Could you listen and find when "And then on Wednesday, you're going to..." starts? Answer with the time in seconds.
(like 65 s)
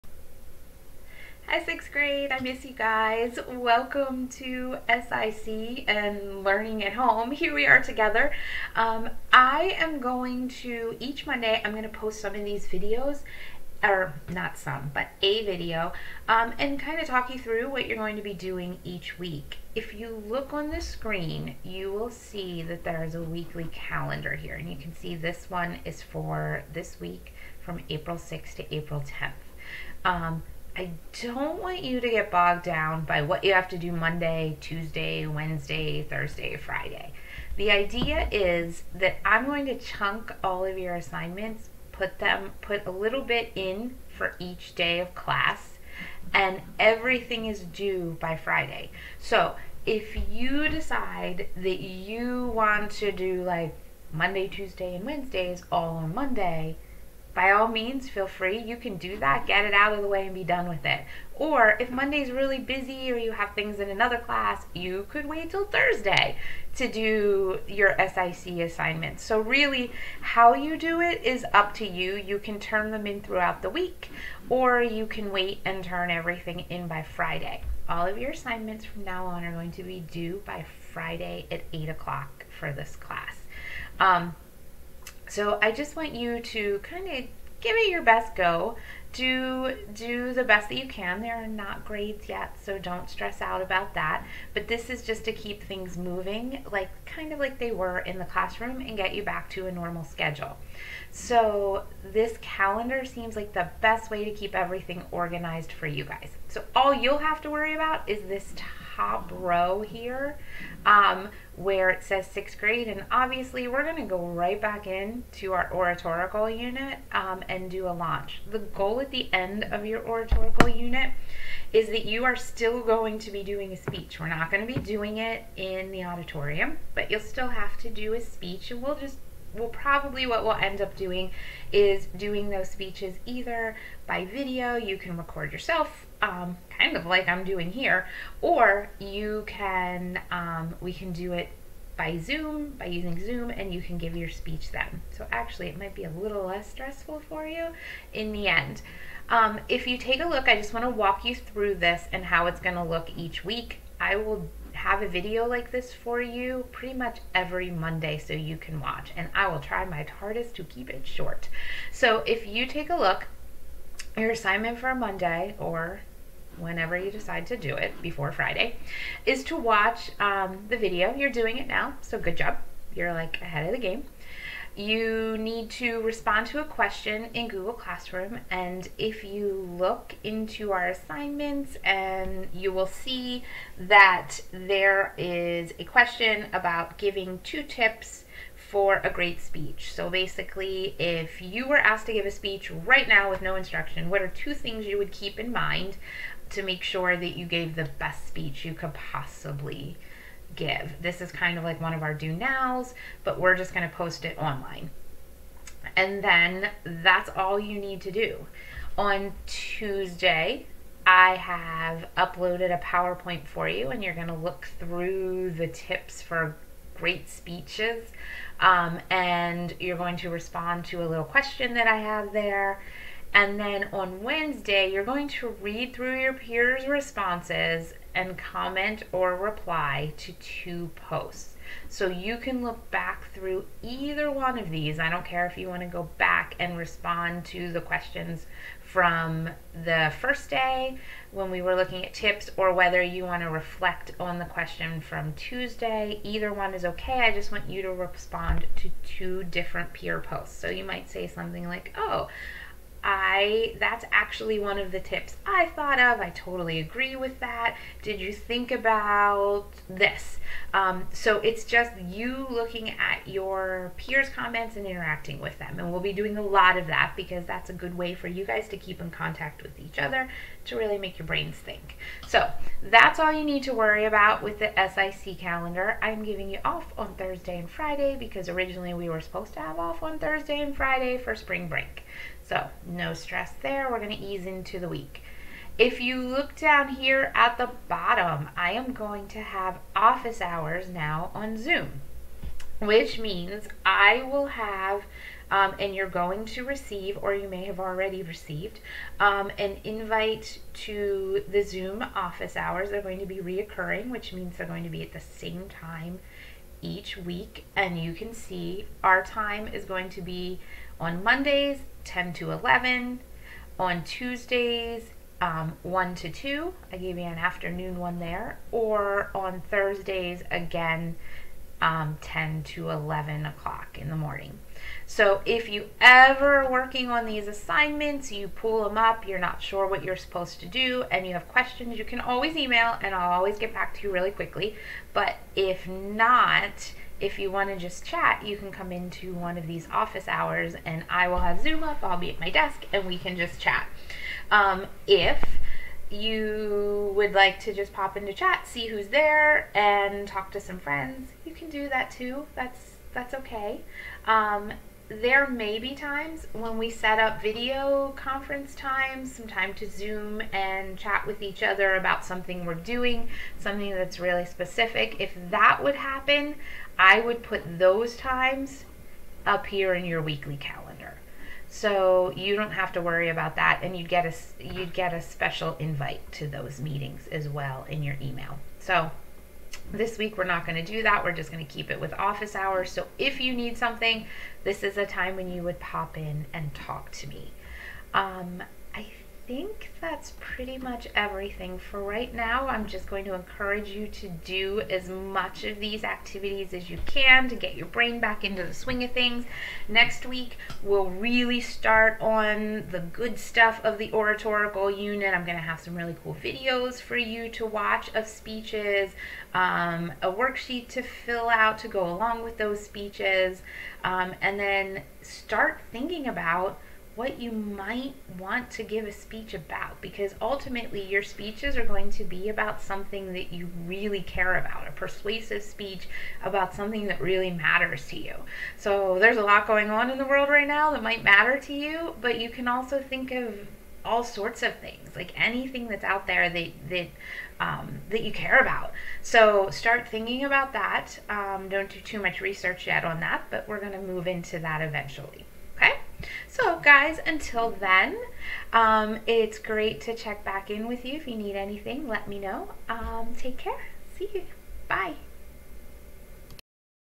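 223 s.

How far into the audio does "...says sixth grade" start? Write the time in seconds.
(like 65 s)
112 s.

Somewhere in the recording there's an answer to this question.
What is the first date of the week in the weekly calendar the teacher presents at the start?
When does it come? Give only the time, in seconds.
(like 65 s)
27 s.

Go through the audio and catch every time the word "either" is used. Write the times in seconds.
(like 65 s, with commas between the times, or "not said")
133 s, 233 s, 246 s.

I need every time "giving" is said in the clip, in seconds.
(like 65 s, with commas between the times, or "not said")
186 s, 276 s.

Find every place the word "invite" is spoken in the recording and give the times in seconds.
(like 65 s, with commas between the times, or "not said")
299 s, 375 s.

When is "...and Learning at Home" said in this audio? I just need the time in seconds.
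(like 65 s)
5 s.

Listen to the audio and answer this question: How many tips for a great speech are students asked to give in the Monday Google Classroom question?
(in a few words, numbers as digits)
2.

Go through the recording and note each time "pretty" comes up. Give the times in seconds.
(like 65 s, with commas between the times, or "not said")
156 s, 390 s.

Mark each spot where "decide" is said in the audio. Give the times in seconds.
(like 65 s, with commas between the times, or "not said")
50 s, 167 s.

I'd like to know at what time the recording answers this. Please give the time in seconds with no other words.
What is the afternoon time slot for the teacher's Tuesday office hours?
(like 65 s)
315 s.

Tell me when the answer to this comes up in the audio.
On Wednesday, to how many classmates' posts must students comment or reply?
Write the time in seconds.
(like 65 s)
230 s.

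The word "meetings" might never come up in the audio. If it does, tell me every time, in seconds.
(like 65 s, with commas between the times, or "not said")
376 s.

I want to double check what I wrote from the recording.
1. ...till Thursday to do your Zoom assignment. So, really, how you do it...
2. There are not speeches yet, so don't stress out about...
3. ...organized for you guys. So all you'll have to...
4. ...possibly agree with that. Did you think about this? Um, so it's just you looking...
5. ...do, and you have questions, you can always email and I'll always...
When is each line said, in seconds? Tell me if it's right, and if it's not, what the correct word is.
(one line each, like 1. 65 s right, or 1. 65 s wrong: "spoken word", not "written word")
1. 65 s wrong: "SIC", not "Zoom"
2. 91 s wrong: "grades", not "speeches"
3. 105 s right
4. 256 s wrong: "totally", not "possibly"
5. 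330 s right.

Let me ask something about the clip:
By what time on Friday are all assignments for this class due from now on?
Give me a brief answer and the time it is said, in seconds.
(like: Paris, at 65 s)
8 o'clock, at 81 s.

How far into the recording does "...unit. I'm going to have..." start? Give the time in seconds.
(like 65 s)
404 s.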